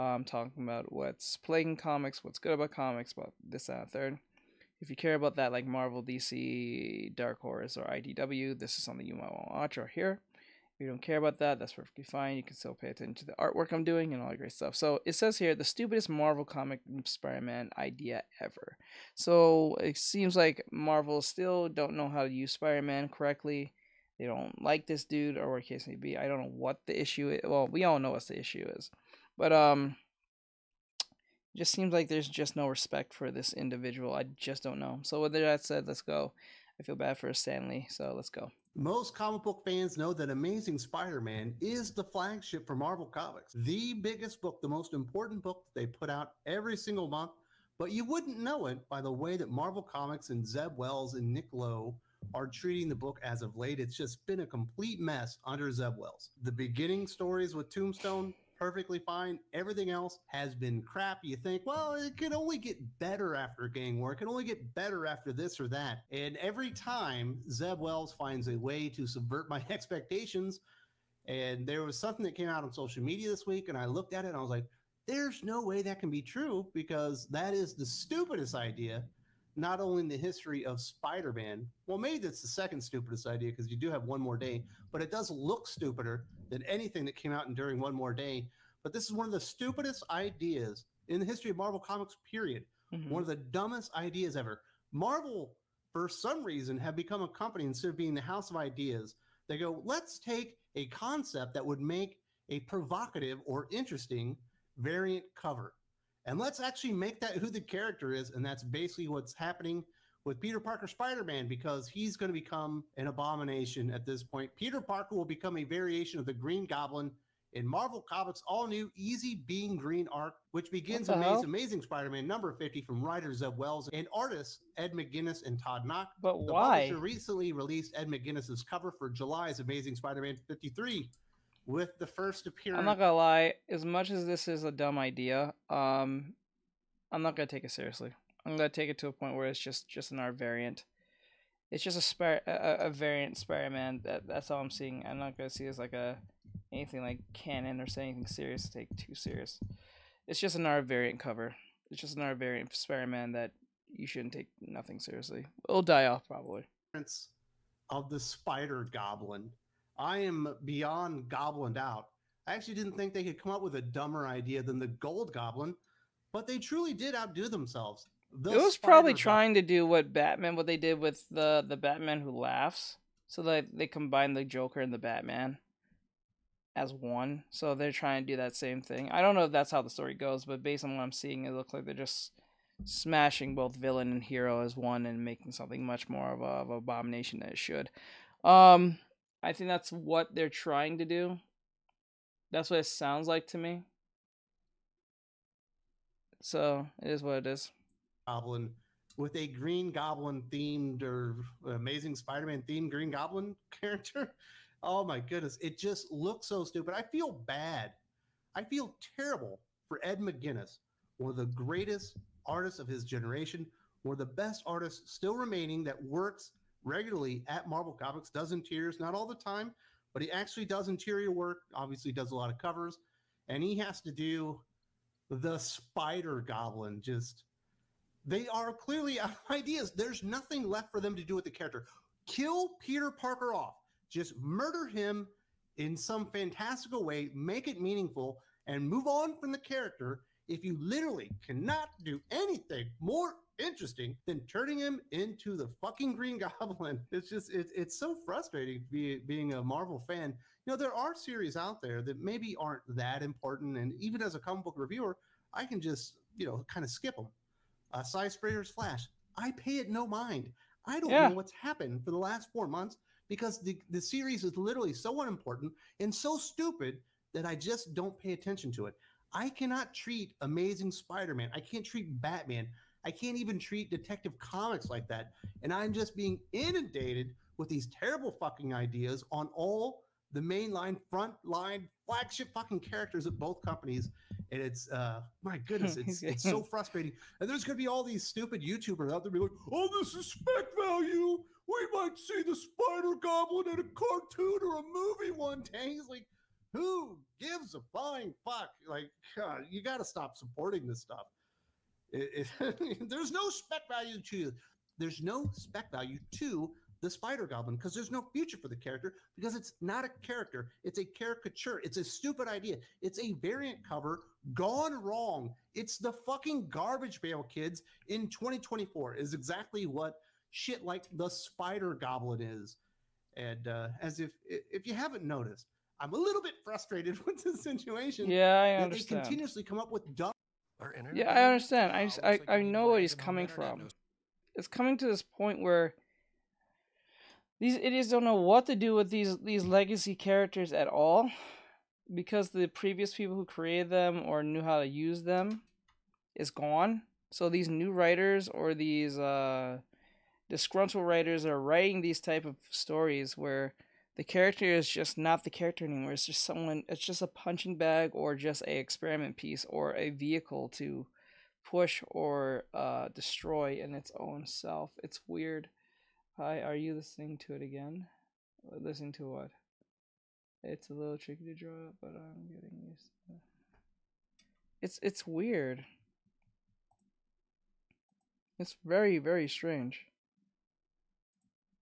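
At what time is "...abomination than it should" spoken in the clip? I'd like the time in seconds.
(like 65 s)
186 s.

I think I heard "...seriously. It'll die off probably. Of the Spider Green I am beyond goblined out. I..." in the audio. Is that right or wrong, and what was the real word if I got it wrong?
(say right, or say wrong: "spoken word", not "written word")
wrong: "Goblin", not "Green".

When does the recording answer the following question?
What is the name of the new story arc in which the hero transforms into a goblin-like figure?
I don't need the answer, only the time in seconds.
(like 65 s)
118 s.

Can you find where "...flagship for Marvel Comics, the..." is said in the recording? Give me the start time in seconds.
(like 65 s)
42 s.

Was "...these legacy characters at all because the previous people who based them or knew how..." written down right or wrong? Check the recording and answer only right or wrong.
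wrong.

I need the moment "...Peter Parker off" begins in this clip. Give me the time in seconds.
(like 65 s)
232 s.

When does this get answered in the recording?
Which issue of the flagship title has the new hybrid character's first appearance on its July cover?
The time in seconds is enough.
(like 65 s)
130 s.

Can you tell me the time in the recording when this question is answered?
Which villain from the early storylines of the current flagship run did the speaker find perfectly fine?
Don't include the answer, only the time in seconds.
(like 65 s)
57 s.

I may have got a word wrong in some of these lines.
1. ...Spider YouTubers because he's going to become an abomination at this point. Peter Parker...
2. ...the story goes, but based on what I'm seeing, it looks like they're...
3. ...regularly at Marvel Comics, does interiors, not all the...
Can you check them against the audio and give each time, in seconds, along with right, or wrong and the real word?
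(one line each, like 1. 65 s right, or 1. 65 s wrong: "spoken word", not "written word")
1. 110 s wrong: "Man", not "YouTubers"
2. 179 s right
3. 216 s right.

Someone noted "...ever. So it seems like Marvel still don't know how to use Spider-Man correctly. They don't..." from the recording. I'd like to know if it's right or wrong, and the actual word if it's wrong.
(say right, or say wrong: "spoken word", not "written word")
right.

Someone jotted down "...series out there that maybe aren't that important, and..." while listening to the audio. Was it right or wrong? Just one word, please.
right.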